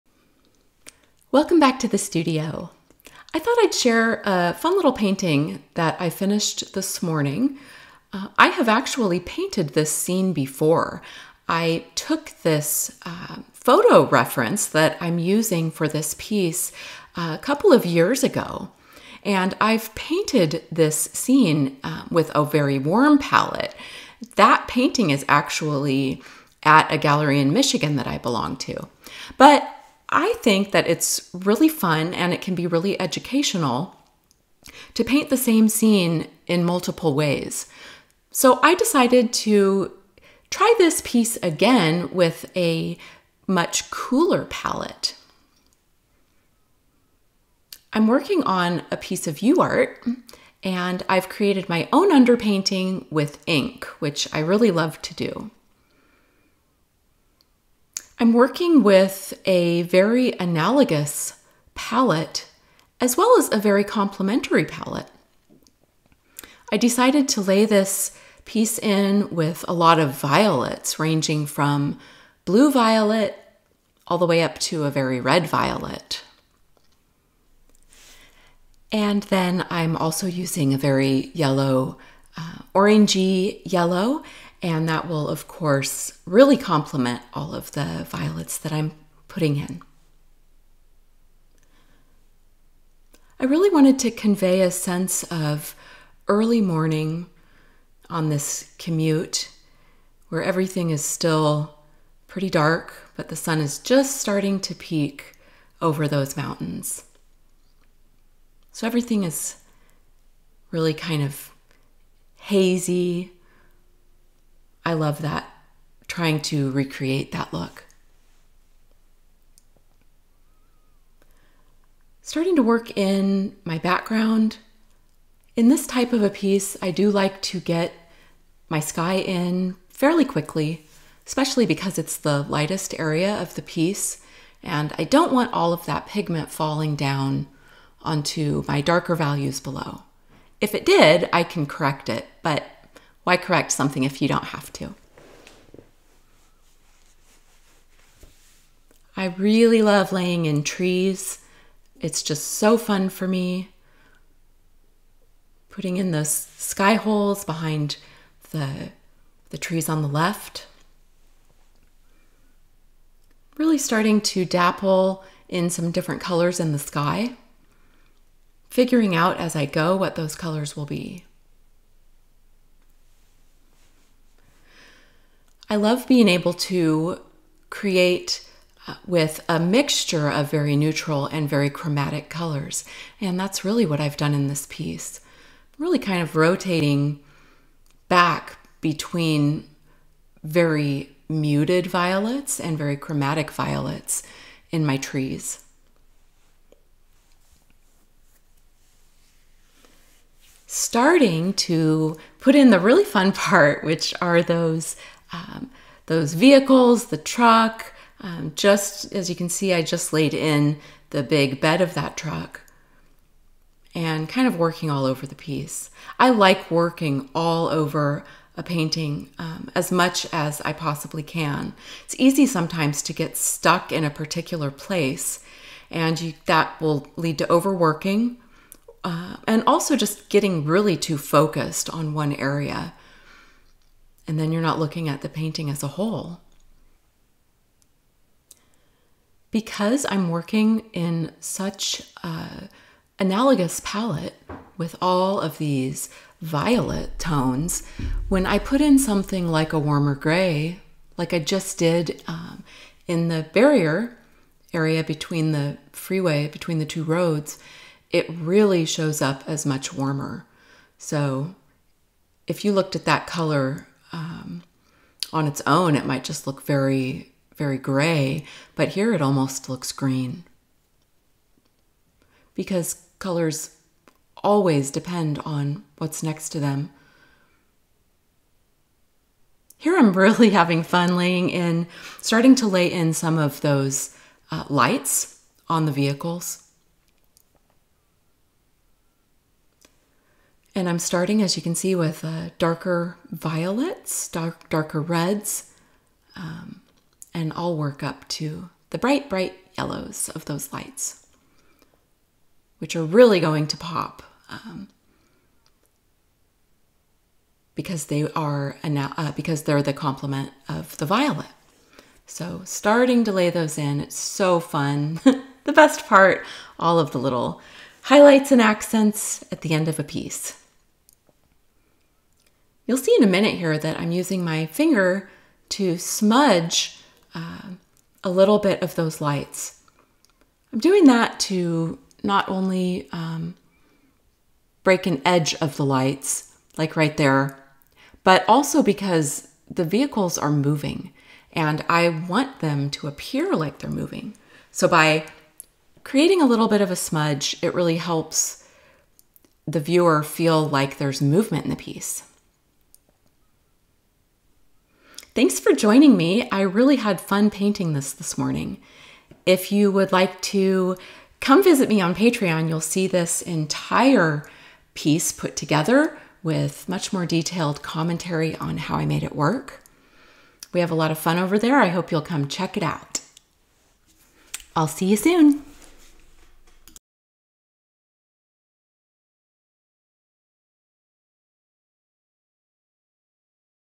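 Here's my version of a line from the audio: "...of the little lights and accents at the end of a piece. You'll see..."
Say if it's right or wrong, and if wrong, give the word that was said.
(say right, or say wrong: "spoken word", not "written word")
wrong: "highlights", not "lights".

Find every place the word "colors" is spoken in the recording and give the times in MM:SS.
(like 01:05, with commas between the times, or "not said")
02:46, 02:50, 03:02, 04:23, 04:33.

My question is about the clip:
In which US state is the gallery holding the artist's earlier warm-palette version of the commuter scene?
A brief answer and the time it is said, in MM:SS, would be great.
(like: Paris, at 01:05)
Michigan, at 00:27.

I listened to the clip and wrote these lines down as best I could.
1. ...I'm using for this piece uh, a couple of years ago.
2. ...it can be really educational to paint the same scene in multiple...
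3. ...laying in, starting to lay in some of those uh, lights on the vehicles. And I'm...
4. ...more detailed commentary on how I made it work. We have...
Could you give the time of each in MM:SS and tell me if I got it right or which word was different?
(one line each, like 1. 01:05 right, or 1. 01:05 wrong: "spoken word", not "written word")
1. 00:14 right
2. 00:32 right
3. 04:41 right
4. 06:07 right.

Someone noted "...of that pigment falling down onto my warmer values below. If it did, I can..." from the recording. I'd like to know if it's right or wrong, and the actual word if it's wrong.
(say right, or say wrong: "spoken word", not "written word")
wrong: "darker", not "warmer".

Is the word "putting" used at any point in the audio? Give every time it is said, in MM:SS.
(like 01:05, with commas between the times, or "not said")
01:29, 02:35.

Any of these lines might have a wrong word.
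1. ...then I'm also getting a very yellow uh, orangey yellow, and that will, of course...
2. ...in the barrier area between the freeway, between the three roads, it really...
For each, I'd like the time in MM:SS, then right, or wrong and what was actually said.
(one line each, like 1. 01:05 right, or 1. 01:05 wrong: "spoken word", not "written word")
1. 01:19 wrong: "using", not "getting"
2. 04:13 wrong: "two", not "three".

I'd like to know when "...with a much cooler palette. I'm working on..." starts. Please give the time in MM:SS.
00:42.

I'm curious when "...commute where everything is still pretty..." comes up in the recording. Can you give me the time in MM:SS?
01:38.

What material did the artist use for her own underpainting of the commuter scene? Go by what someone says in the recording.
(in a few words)
Ink.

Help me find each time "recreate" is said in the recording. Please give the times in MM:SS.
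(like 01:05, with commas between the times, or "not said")
01:56.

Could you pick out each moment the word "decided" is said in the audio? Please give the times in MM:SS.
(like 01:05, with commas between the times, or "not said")
00:38, 01:06.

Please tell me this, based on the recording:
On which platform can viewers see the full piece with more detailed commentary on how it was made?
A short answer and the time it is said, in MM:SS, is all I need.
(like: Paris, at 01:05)
Patreon, at 06:02.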